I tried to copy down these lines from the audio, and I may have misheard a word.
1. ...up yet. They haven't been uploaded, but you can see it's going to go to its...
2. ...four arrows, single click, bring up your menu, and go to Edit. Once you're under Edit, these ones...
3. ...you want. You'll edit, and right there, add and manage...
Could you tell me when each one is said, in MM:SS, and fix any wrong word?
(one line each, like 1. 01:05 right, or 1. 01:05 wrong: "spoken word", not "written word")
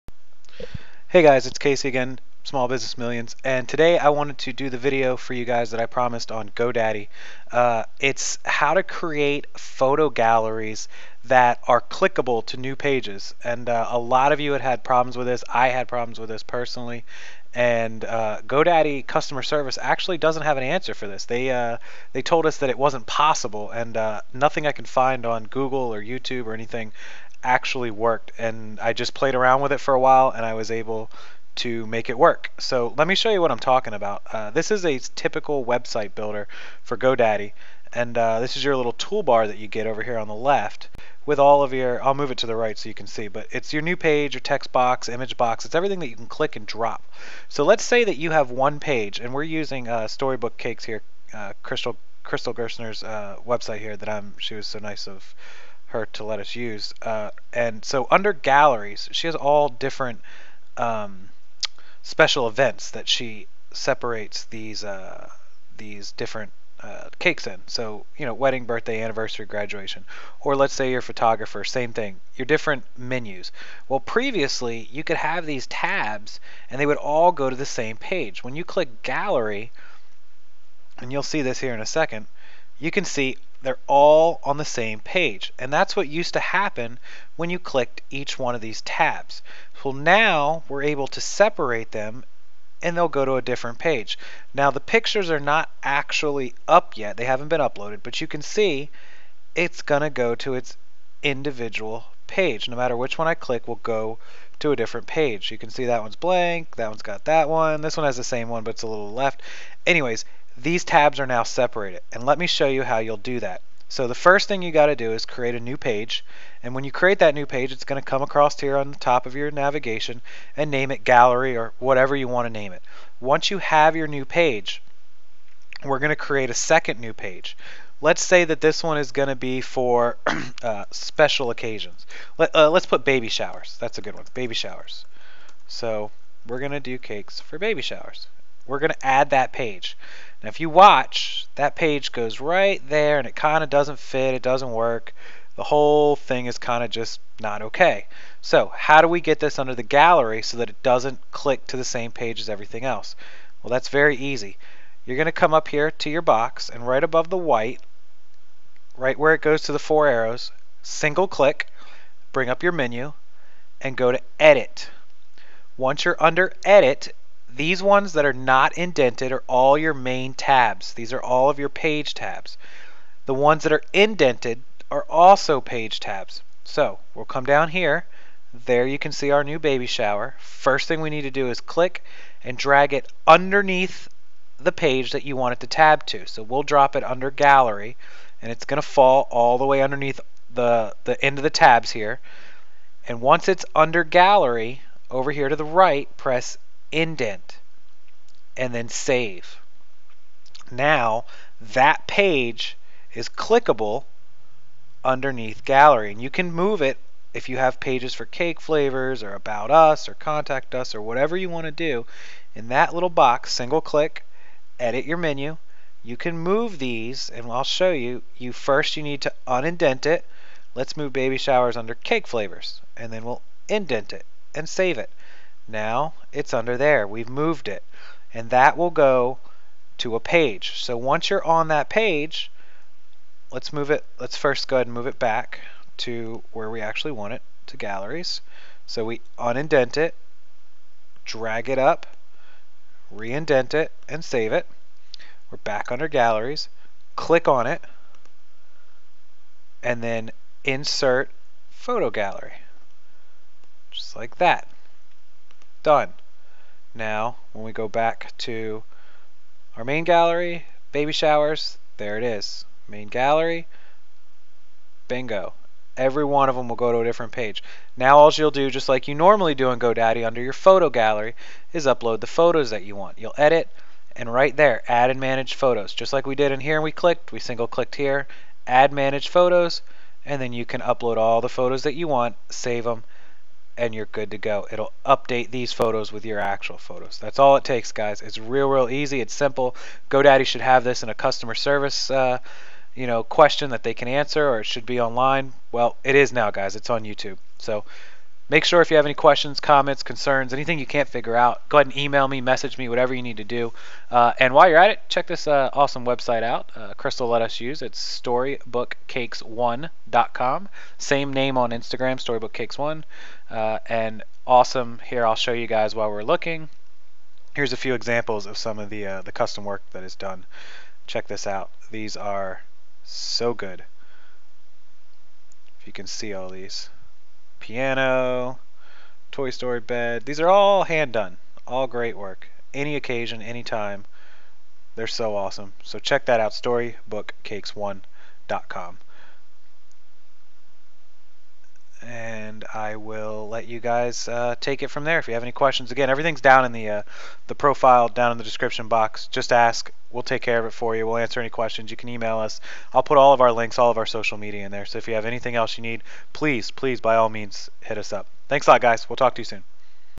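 1. 01:36 right
2. 02:39 right
3. 04:32 right.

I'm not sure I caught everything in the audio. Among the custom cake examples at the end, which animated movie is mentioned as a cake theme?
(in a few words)
Toy Story.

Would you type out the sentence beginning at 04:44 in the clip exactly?
It'll update these photos with your actual photos.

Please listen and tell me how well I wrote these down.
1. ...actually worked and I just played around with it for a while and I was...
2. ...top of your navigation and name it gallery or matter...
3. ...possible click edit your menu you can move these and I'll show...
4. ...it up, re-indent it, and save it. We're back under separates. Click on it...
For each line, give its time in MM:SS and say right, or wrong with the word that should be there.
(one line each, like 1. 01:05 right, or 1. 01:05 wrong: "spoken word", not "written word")
1. 00:27 right
2. 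01:58 wrong: "whatever", not "matter"
3. 03:33 wrong: "single", not "possible"
4. 04:01 wrong: "galleries", not "separates".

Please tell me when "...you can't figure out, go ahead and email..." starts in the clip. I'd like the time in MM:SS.
05:00.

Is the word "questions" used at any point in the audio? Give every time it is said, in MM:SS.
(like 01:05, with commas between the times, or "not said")
04:53, 04:59, 05:45, 05:51.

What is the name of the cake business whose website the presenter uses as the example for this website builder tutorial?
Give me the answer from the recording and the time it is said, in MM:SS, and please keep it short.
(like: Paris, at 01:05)
Storybook Cakes, at 00:50.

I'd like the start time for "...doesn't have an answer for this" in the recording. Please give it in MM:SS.
00:20.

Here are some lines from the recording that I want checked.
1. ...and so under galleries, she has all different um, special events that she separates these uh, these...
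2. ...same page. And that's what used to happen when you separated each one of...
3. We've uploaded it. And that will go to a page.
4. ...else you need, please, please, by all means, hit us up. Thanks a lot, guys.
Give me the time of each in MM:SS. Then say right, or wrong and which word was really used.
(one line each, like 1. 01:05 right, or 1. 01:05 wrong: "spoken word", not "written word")
1. 00:57 right
2. 01:24 wrong: "clicked", not "separated"
3. 03:47 wrong: "moved", not "uploaded"
4. 05:55 right.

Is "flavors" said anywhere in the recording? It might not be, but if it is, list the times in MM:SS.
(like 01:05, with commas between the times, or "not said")
03:28, 03:42.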